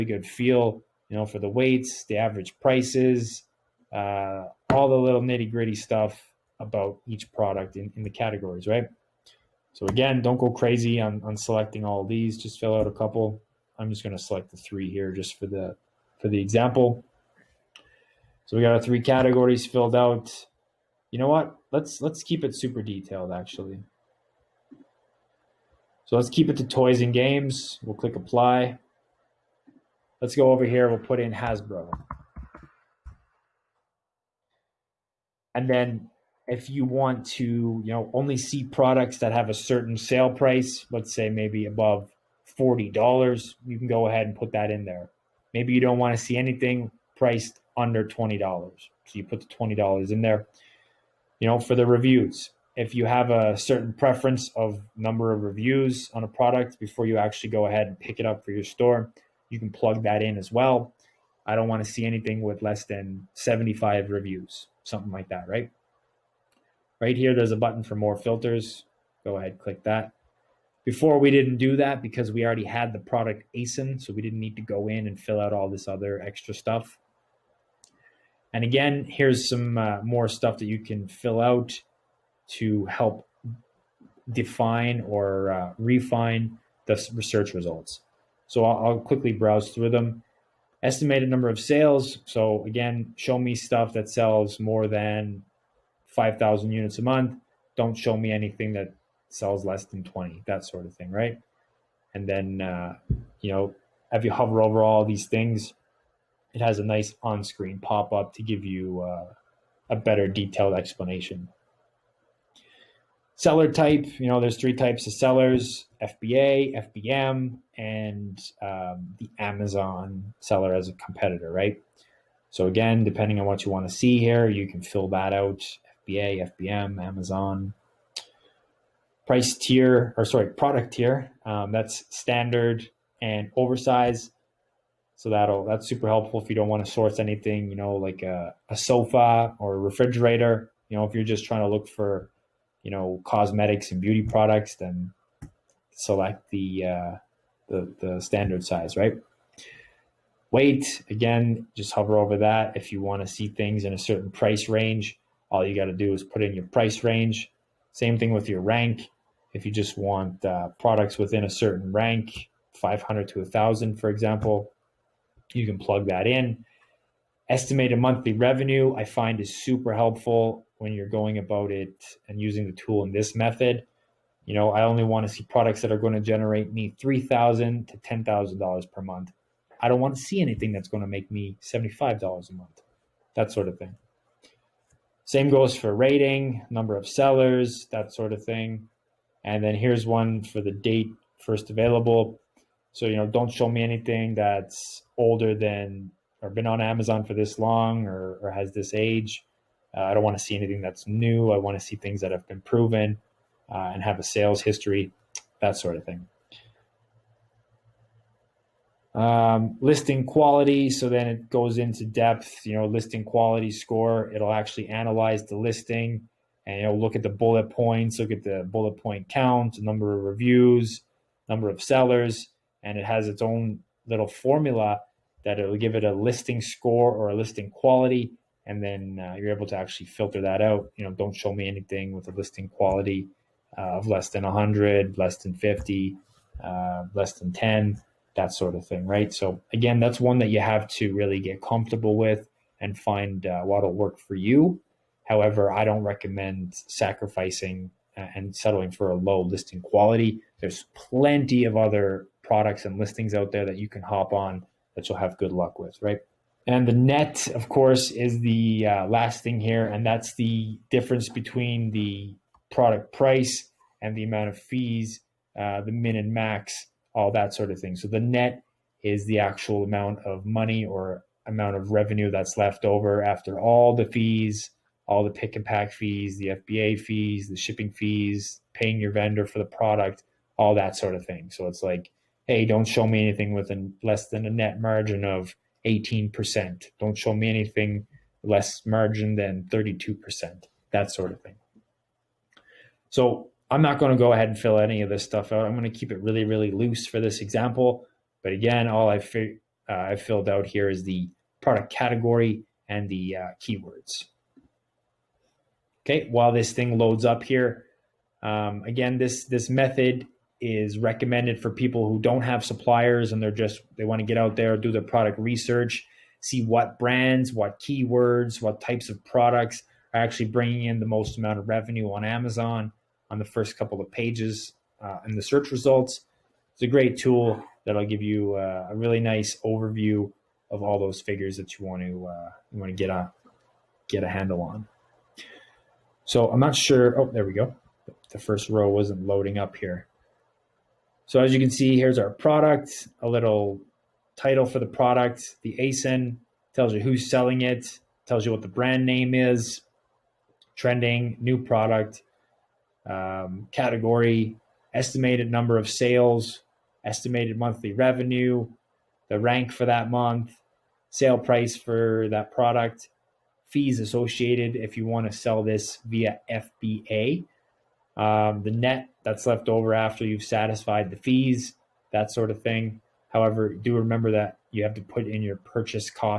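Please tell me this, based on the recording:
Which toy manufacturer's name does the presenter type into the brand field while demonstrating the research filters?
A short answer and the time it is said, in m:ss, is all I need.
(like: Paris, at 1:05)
Hasbro, at 0:31.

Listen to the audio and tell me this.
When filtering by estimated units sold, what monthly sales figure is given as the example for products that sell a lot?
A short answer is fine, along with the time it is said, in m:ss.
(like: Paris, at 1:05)
5,000, at 1:36.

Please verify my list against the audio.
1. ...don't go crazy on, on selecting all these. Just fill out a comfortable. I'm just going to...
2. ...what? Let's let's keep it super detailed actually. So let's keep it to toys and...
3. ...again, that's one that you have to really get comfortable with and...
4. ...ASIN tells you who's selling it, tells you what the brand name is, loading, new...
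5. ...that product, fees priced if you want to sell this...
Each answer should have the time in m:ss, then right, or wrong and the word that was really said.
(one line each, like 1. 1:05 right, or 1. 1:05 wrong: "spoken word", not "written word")
1. 0:10 wrong: "couple", not "comfortable"
2. 0:21 right
3. 3:59 right
4. 5:45 wrong: "trending", not "loading"
5. 6:02 wrong: "associated", not "priced".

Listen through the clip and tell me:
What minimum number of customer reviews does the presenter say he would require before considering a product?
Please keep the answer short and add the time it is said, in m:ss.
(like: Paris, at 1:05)
75, at 1:03.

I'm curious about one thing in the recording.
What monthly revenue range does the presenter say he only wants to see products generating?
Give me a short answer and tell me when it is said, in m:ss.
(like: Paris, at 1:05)
$3,000 to $10,000, at 2:57.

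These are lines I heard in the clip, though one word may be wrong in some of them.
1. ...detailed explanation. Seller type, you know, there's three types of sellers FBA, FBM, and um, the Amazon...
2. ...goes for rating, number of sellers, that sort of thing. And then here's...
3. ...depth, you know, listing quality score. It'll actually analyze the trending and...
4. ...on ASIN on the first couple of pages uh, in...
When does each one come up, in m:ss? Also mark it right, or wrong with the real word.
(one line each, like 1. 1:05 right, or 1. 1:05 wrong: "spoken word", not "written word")
1. 1:50 right
2. 3:05 right
3. 3:32 wrong: "listing", not "trending"
4. 5:22 wrong: "Amazon", not "ASIN".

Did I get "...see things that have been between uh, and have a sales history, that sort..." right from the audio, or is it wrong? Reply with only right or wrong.
wrong.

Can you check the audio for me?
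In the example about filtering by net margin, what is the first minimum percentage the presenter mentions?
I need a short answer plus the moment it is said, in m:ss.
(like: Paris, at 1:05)
18%, at 4:45.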